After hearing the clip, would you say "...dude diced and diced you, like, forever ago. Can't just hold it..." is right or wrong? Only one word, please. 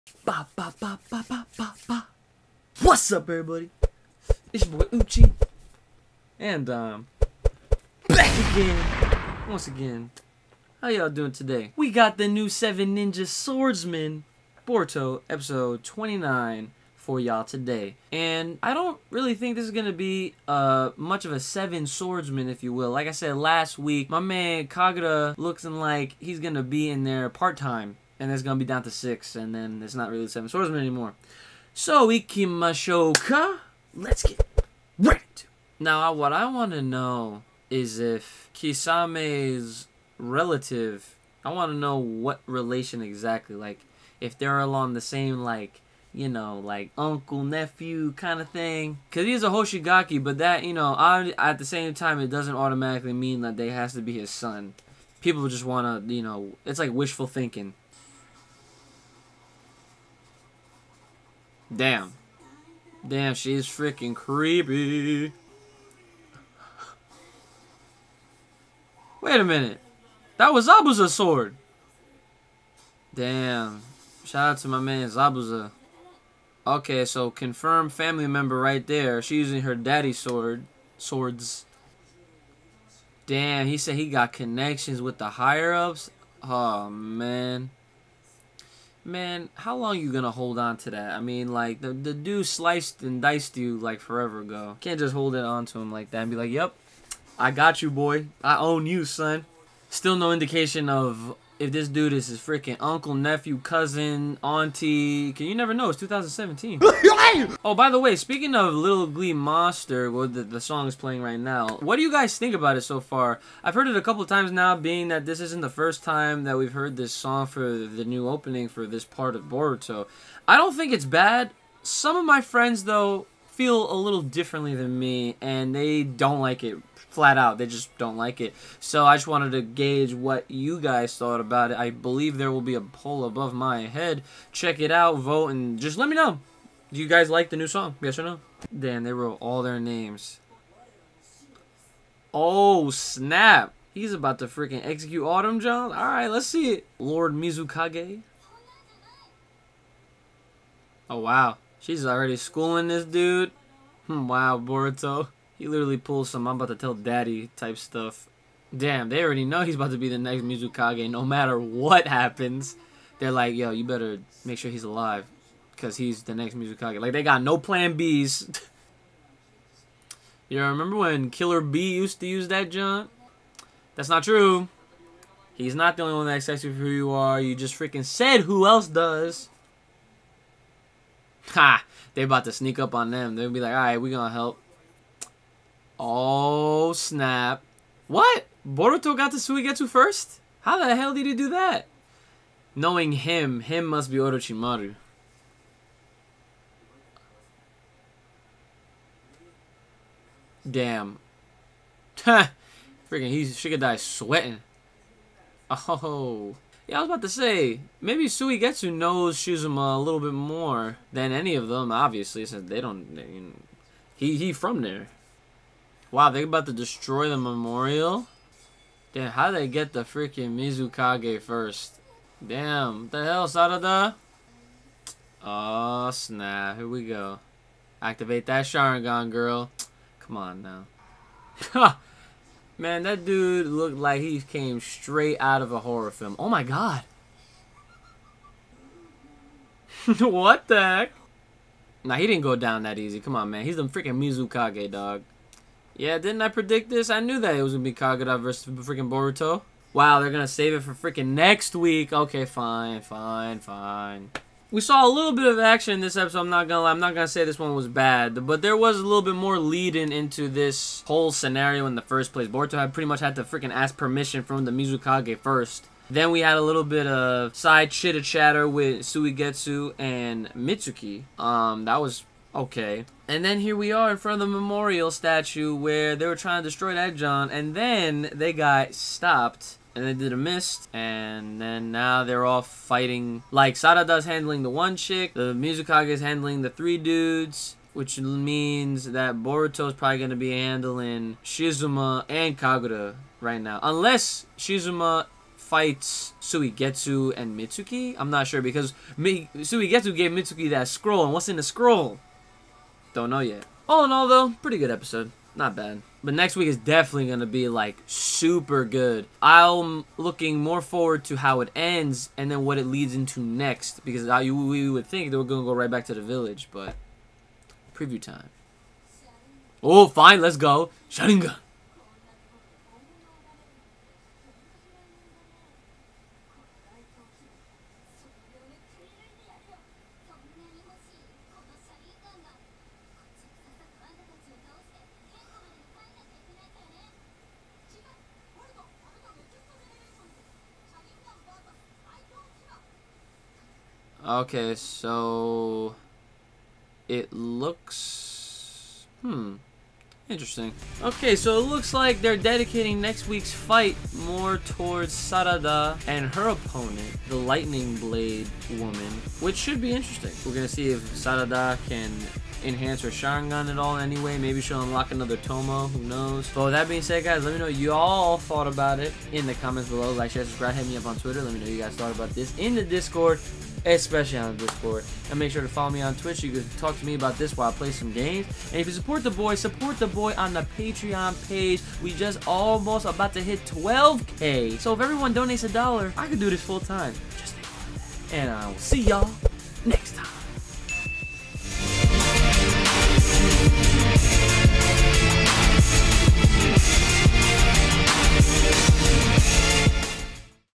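wrong.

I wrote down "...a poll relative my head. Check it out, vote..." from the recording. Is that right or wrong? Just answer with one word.
wrong.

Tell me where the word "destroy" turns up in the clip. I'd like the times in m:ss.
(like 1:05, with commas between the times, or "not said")
3:36, 4:36.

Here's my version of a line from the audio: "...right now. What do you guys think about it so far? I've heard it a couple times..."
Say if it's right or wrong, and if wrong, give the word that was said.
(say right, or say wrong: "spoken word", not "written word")
right.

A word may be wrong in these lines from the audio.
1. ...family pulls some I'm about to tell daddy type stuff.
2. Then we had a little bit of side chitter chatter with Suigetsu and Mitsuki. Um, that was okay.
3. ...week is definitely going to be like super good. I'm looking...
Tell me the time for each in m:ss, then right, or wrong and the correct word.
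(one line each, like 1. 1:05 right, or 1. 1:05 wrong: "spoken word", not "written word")
1. 2:35 wrong: "literally", not "family"
2. 4:26 right
3. 5:06 right.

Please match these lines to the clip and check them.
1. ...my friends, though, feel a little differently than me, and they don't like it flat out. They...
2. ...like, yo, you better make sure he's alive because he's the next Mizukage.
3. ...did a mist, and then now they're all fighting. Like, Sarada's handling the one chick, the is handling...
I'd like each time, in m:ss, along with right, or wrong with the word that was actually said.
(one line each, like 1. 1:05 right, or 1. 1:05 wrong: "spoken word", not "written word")
1. 2:02 right
2. 2:43 right
3. 4:40 right.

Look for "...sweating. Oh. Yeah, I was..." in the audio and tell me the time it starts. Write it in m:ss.
3:23.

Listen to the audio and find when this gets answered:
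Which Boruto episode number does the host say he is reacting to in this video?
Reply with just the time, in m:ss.
0:15.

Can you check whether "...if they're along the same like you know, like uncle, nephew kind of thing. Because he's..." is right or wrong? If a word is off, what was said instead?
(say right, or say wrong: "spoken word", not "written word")
right.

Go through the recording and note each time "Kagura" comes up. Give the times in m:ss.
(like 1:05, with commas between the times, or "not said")
0:24, 4:07, 4:52.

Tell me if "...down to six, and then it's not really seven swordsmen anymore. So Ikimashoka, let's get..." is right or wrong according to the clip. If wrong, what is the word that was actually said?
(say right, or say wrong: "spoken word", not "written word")
right.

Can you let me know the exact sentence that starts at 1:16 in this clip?
Okay, so confirm family member right there.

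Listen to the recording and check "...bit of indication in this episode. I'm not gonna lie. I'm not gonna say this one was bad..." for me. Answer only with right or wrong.
wrong.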